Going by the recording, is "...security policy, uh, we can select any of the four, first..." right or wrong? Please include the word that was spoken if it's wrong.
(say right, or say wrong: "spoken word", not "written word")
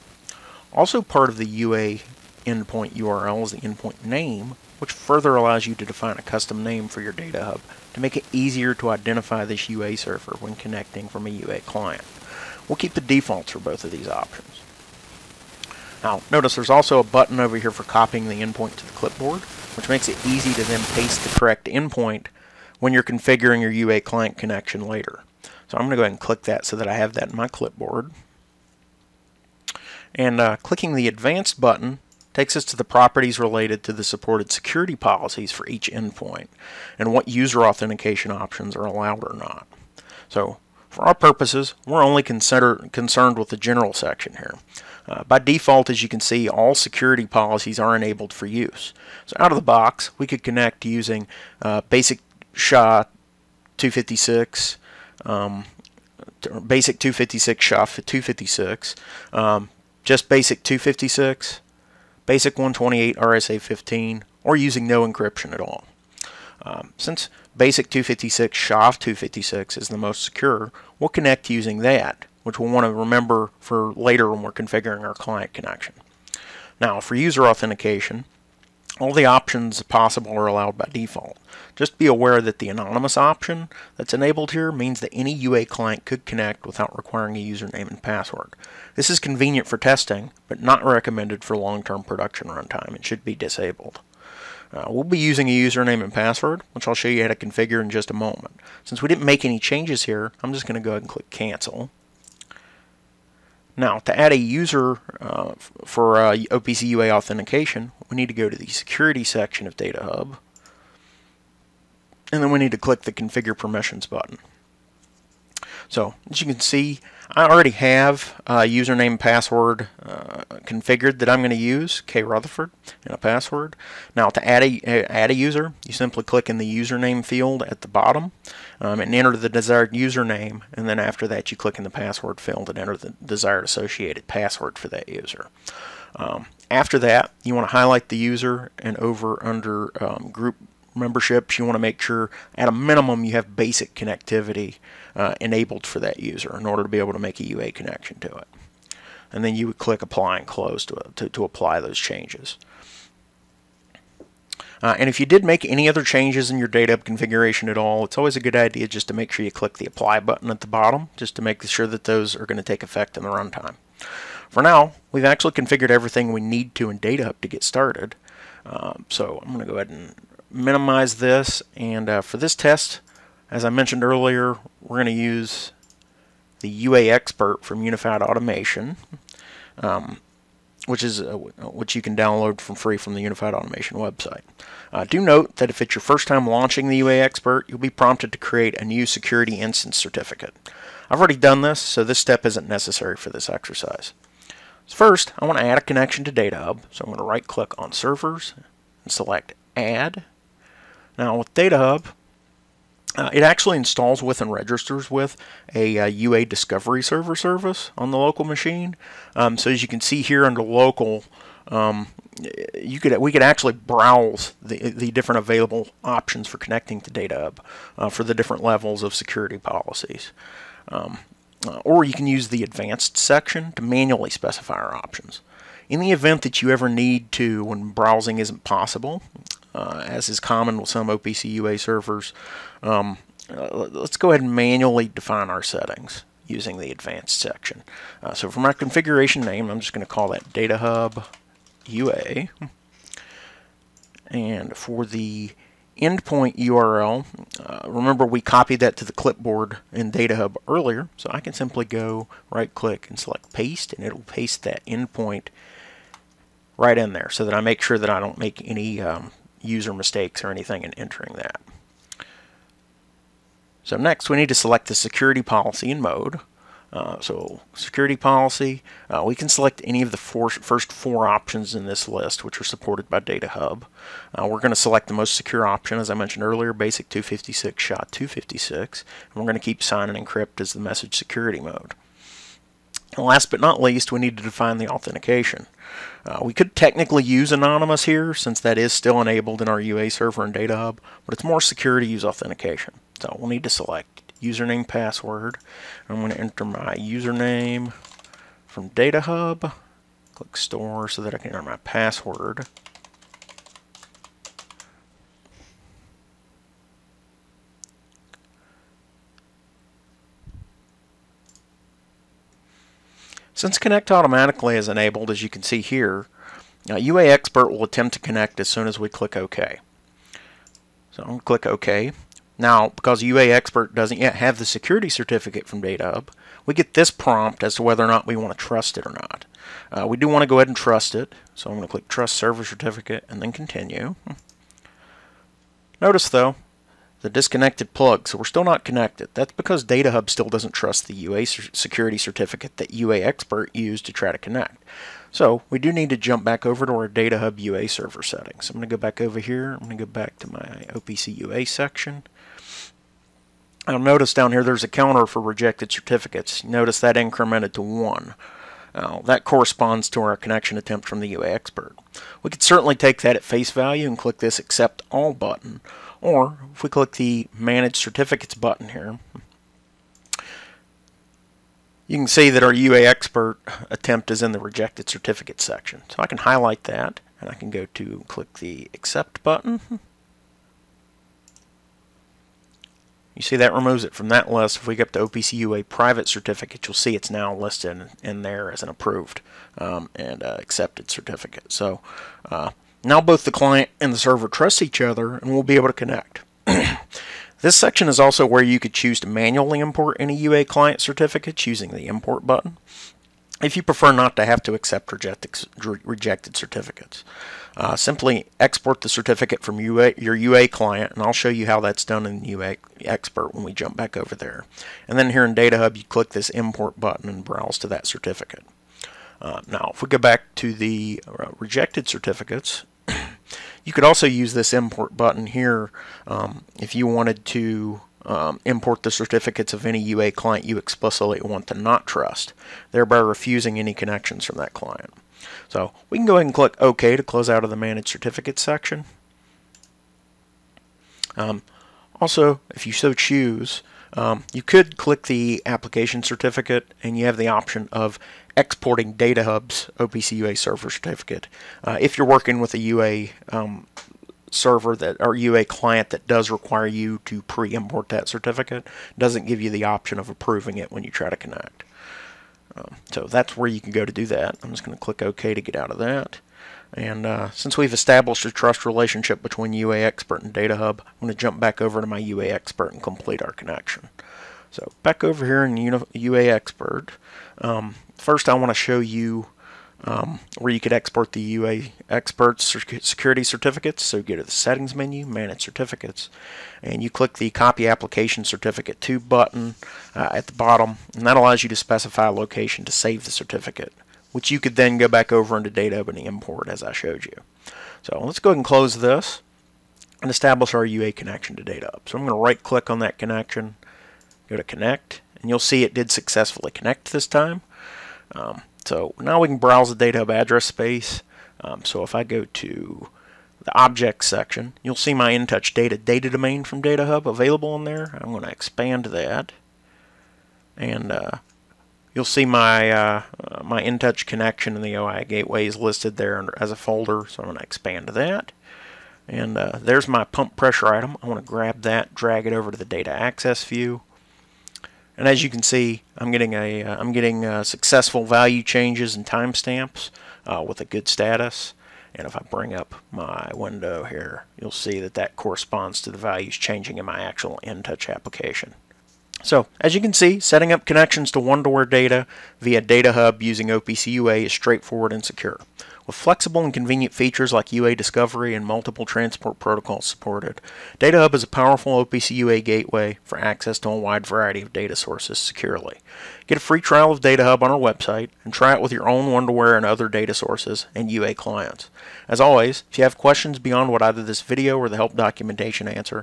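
right.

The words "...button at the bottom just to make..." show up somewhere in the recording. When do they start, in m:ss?
2:40.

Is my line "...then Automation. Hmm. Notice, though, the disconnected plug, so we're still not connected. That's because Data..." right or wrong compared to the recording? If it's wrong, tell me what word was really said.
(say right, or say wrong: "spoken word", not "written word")
wrong: "Continue", not "Automation".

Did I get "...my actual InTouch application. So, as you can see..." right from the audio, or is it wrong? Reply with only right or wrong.
right.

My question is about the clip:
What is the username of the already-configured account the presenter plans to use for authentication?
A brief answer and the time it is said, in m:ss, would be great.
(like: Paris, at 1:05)
K Rutherford, at 2:02.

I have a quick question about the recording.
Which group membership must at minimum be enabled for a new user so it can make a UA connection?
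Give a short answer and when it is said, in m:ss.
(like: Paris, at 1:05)
basic connectivity, at 2:23.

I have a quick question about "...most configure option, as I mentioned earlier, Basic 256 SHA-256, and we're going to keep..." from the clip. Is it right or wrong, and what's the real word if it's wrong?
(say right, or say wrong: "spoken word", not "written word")
wrong: "secure", not "configure".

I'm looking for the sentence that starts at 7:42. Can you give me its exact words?
Um, so that's where you can go to do that.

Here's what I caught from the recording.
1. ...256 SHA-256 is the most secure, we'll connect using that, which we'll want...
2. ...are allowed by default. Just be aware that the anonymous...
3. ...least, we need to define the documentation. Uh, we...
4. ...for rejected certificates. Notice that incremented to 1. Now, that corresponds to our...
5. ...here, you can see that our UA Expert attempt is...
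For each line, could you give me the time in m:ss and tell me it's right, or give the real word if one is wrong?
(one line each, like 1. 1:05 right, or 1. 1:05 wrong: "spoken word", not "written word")
1. 1:07 right
2. 1:20 right
3. 4:43 wrong: "authentication", not "documentation"
4. 5:55 right
5. 6:08 right.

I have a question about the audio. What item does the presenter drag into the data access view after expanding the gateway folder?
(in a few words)
pump pressure.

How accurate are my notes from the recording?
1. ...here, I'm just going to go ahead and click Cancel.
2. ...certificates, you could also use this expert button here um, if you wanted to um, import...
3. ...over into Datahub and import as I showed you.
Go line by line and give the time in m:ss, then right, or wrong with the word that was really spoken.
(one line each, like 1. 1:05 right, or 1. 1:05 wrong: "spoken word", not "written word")
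1. 1:40 right
2. 7:02 wrong: "import", not "expert"
3. 8:15 right.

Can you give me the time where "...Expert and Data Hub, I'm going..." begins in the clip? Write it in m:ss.
7:49.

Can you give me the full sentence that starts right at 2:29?
And then you would click apply and close to, to, to apply those changes.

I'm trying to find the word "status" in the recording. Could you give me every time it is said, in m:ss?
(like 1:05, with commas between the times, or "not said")
9:01.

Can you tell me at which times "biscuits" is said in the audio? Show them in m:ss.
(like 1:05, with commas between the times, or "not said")
not said.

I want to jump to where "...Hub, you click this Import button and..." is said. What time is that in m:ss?
6:55.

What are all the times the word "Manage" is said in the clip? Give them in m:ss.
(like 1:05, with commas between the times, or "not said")
6:07, 7:17, 8:05.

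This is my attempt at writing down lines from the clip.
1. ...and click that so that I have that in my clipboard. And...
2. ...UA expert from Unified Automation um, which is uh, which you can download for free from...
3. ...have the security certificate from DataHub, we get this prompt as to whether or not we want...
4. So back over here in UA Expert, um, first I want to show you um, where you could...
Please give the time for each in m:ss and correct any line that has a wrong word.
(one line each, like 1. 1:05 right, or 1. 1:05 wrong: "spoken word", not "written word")
1. 0:26 right
2. 2:56 right
3. 5:24 right
4. 7:54 right.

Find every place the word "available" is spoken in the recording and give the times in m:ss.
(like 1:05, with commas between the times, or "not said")
3:35, 8:37.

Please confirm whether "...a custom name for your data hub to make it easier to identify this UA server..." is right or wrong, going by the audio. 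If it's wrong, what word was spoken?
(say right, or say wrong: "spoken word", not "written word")
right.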